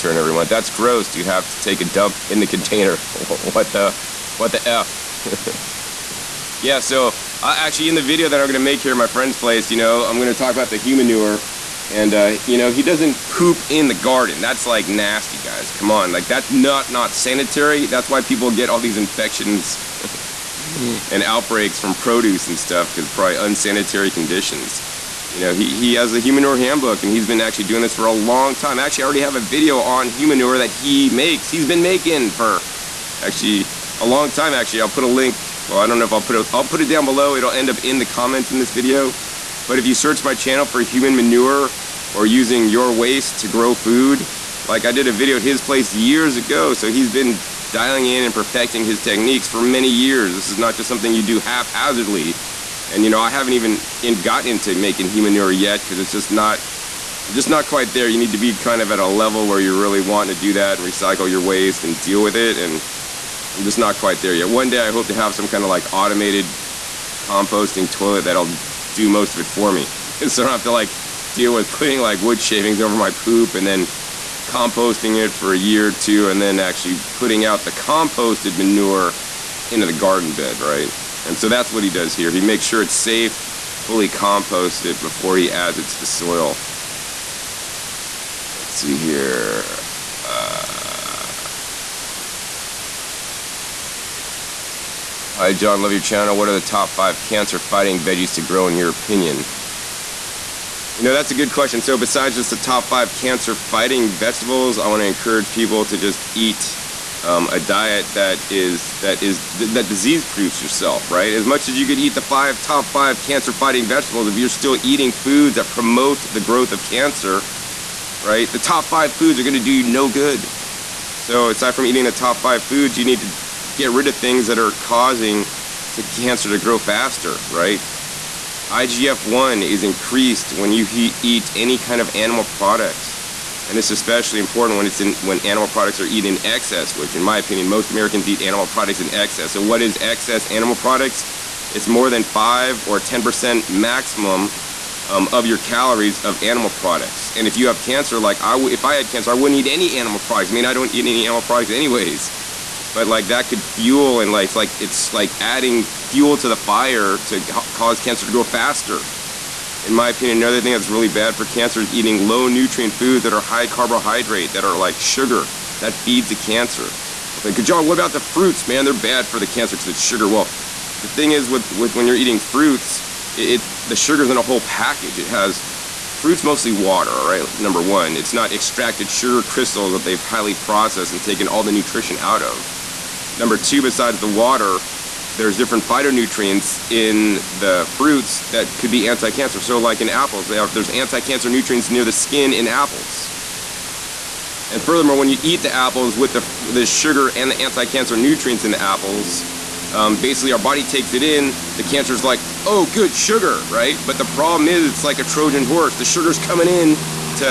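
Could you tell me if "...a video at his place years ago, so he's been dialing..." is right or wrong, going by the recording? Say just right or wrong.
right.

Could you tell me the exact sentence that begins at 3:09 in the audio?
So like in apples, there's anti-cancer nutrients near the skin in apples.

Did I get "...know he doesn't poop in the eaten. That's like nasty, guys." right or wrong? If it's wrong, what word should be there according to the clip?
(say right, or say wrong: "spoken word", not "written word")
wrong: "garden", not "eaten".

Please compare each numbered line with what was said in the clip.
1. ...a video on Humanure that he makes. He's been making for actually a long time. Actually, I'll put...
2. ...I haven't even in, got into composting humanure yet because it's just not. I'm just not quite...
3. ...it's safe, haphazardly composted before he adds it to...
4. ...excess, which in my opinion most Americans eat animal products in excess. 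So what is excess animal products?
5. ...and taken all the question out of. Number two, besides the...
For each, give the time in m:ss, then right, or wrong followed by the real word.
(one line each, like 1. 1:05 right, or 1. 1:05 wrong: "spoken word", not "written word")
1. 0:29 right
2. 0:53 wrong: "making", not "composting"
3. 1:22 wrong: "fully", not "haphazardly"
4. 2:16 right
5. 3:01 wrong: "nutrition", not "question".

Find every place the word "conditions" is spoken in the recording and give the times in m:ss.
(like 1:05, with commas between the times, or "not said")
0:24.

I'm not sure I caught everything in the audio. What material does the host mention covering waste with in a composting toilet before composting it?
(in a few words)
wood shavings.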